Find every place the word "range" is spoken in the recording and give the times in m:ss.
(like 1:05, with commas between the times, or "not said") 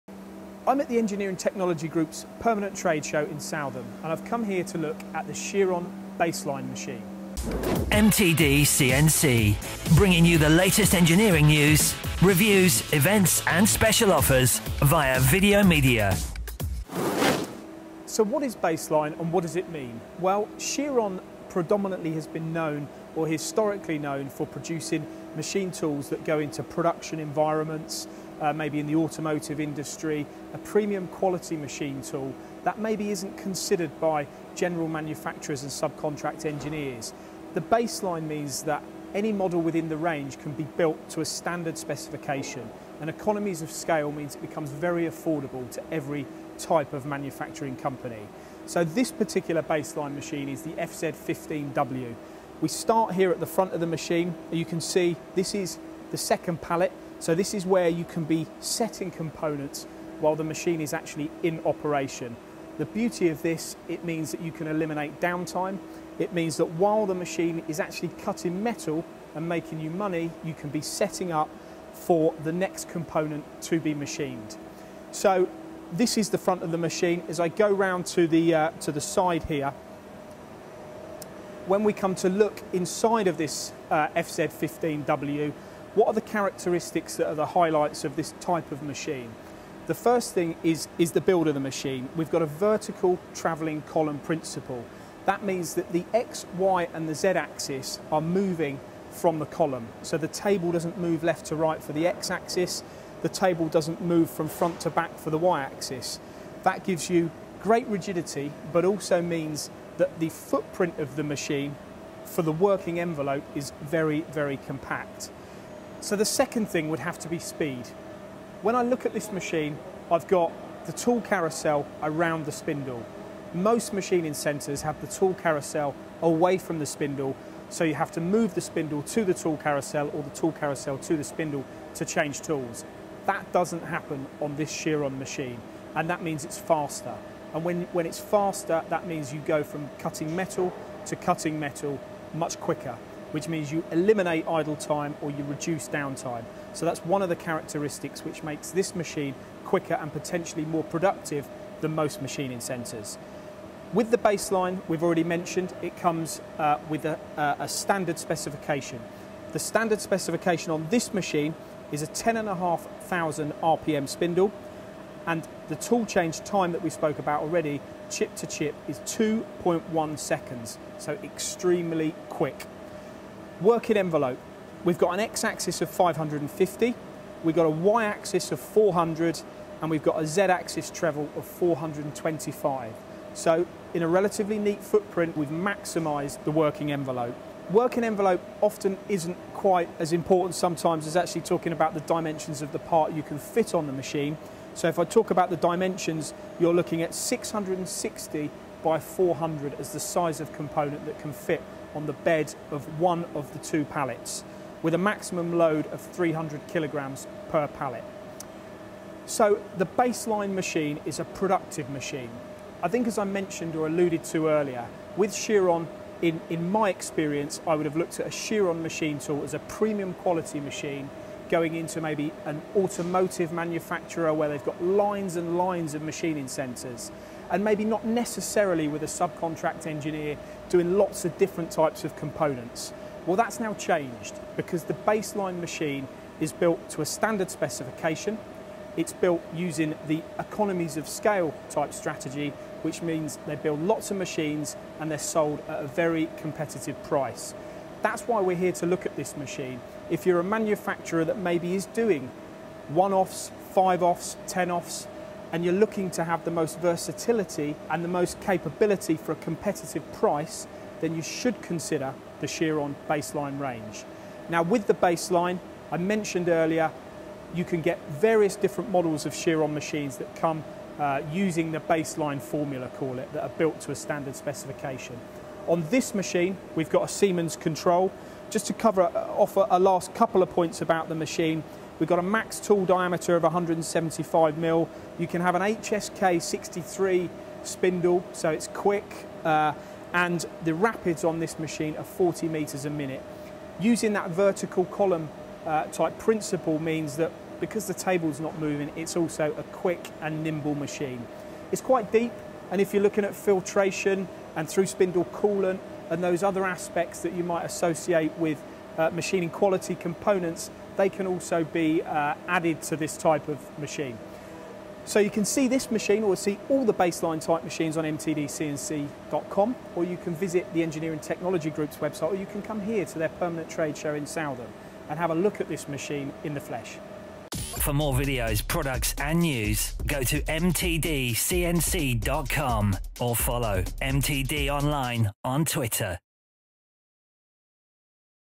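0:39, 4:23.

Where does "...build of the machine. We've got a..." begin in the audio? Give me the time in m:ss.
1:31.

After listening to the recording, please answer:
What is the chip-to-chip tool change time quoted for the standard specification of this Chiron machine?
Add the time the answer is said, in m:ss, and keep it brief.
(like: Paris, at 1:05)
2.1 seconds, at 2:48.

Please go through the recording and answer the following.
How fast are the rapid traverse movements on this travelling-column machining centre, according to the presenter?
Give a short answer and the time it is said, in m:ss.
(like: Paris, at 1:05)
40 meters a minute, at 4:52.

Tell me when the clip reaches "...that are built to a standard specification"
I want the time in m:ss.
4:33.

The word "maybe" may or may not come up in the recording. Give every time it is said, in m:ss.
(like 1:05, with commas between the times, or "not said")
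0:28, 0:32, 3:42, 3:47, 4:11.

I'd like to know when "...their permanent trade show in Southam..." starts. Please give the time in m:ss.
5:23.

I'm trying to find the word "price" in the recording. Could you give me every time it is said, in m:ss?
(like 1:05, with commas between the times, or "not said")
4:07, 4:20.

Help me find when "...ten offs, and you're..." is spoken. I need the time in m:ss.
4:14.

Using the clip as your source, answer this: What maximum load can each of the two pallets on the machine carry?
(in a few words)
300 kilograms.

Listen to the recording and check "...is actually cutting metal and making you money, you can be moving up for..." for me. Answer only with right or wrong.
wrong.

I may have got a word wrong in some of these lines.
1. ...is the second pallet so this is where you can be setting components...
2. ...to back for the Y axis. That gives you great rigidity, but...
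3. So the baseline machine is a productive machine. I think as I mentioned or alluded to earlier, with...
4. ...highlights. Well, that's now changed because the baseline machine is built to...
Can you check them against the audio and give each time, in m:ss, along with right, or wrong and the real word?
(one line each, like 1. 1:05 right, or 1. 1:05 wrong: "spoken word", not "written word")
1. 0:55 right
2. 1:44 right
3. 3:29 right
4. 3:52 wrong: "components", not "highlights".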